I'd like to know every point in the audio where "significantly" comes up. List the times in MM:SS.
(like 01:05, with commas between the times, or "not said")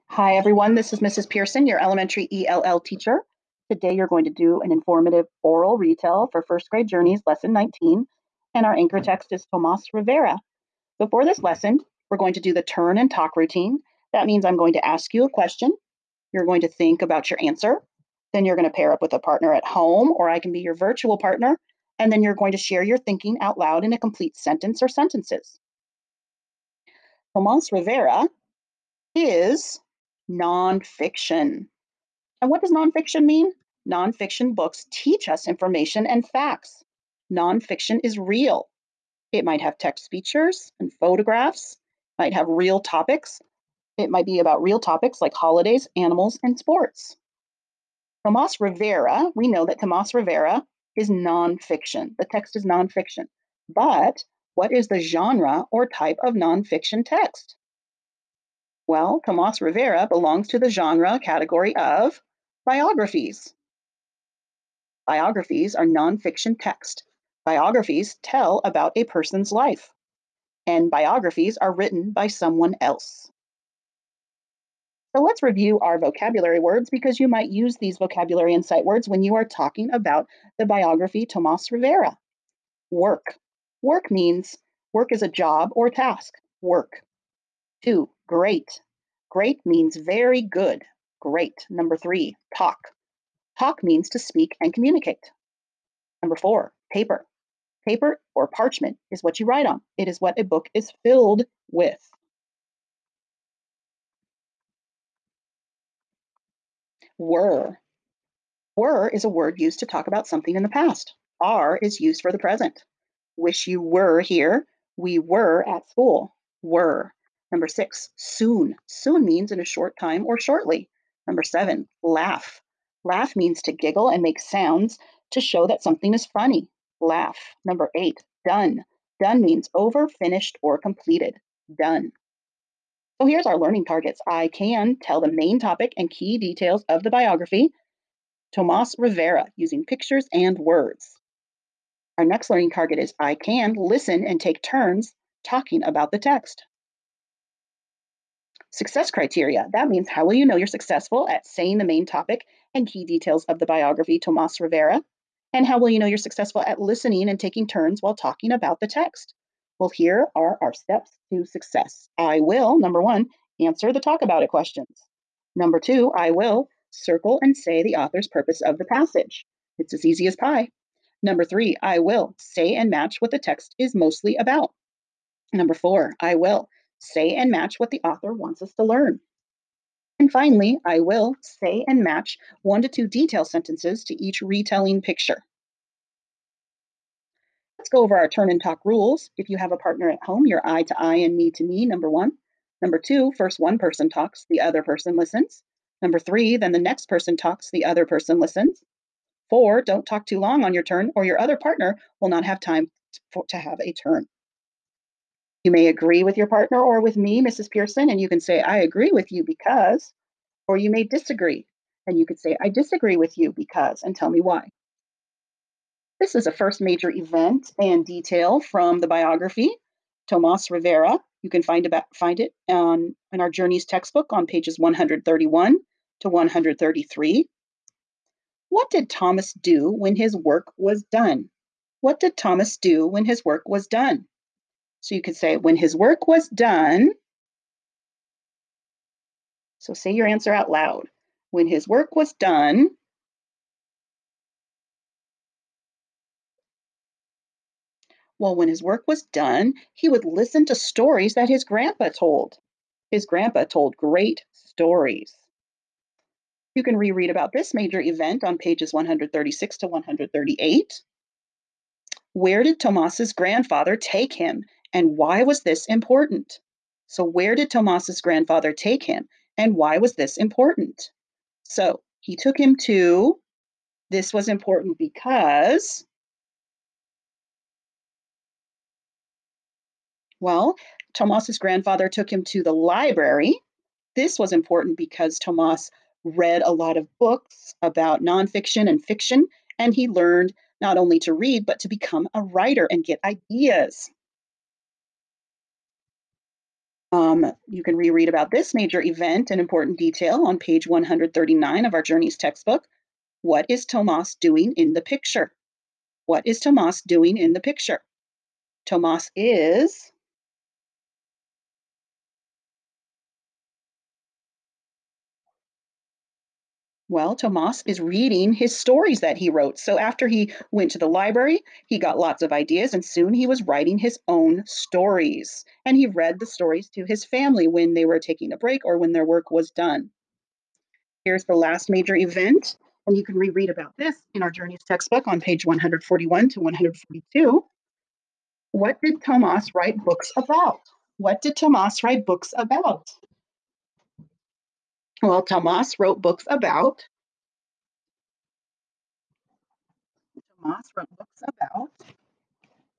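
not said.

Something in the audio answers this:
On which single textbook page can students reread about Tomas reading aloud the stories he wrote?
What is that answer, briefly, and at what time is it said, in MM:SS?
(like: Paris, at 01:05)
139, at 05:00.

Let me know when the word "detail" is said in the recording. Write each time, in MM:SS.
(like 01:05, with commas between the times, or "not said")
02:16, 02:33, 03:03, 03:38, 04:59.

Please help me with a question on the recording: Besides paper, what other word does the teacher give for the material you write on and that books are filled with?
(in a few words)
Parchment.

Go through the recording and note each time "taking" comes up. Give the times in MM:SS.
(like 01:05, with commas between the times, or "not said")
02:37, 05:28.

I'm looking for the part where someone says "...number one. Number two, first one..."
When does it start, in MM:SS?
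03:11.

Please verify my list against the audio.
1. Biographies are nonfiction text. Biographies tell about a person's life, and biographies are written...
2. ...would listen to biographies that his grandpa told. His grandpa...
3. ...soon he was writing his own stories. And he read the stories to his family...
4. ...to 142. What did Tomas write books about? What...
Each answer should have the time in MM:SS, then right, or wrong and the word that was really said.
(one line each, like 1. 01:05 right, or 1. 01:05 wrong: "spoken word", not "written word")
1. 01:05 right
2. 04:10 wrong: "stories", not "biographies"
3. 05:23 right
4. 05:36 right.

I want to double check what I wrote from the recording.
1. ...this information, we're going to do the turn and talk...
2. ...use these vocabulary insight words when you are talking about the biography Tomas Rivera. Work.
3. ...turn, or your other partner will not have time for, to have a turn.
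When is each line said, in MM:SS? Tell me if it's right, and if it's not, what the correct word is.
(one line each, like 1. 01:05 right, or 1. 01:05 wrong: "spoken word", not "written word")
1. 00:11 wrong: "lesson", not "information"
2. 01:17 right
3. 03:20 right.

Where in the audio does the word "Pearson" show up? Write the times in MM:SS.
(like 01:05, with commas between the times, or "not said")
00:01, 03:27.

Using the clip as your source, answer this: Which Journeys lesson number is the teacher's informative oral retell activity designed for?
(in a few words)
19.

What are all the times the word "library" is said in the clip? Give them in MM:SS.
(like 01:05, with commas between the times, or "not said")
04:42, 05:21.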